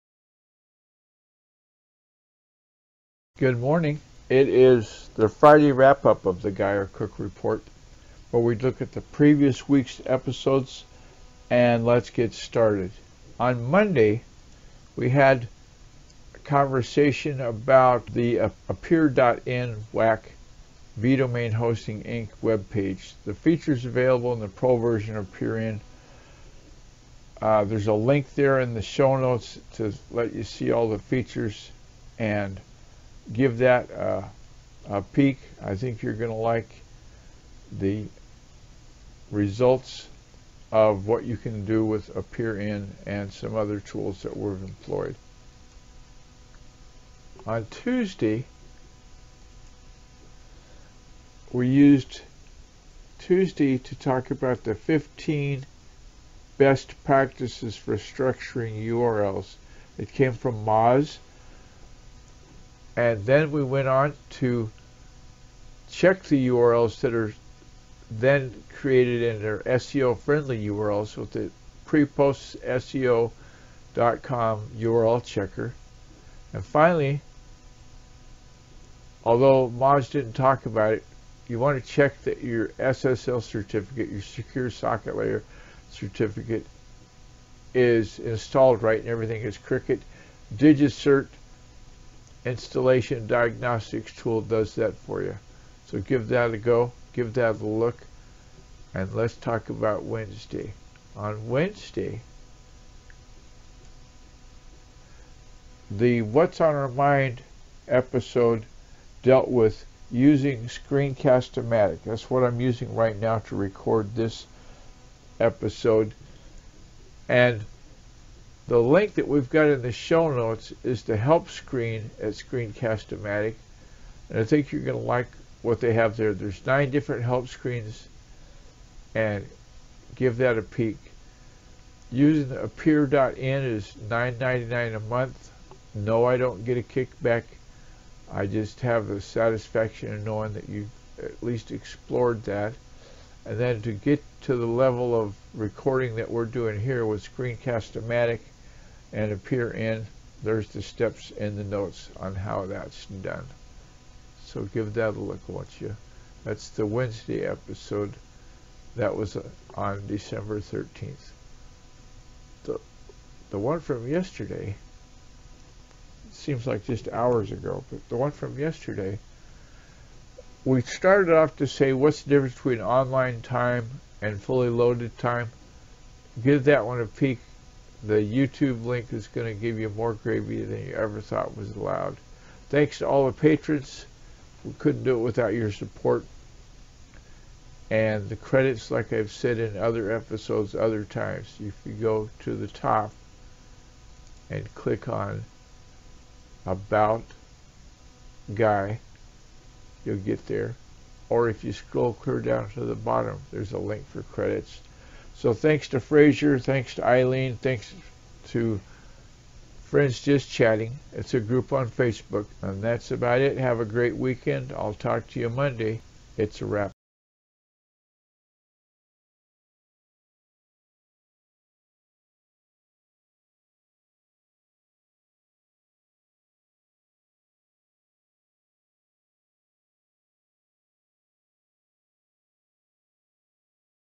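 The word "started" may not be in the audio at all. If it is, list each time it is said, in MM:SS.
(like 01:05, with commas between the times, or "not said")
00:12, 02:50.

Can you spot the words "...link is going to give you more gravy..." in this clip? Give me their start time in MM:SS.
02:58.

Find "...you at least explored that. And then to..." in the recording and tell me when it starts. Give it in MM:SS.
02:20.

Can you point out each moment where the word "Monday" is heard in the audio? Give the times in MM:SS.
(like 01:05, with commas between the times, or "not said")
00:13, 03:35.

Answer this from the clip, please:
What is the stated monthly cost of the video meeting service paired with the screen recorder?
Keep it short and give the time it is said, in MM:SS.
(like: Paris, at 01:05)
$9.99, at 02:14.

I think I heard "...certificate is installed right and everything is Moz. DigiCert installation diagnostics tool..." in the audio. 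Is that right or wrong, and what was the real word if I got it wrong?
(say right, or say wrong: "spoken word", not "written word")
wrong: "Cricut", not "Moz".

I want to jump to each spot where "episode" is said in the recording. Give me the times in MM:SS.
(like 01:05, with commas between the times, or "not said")
00:10, 01:47, 01:55, 02:37, 03:10.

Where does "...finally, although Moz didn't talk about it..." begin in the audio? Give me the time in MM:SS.
01:16.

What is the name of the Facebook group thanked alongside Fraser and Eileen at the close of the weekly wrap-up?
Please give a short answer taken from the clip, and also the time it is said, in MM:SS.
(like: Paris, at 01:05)
Friends Just Chatting, at 03:29.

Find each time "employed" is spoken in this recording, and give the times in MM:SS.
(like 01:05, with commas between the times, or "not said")
00:44.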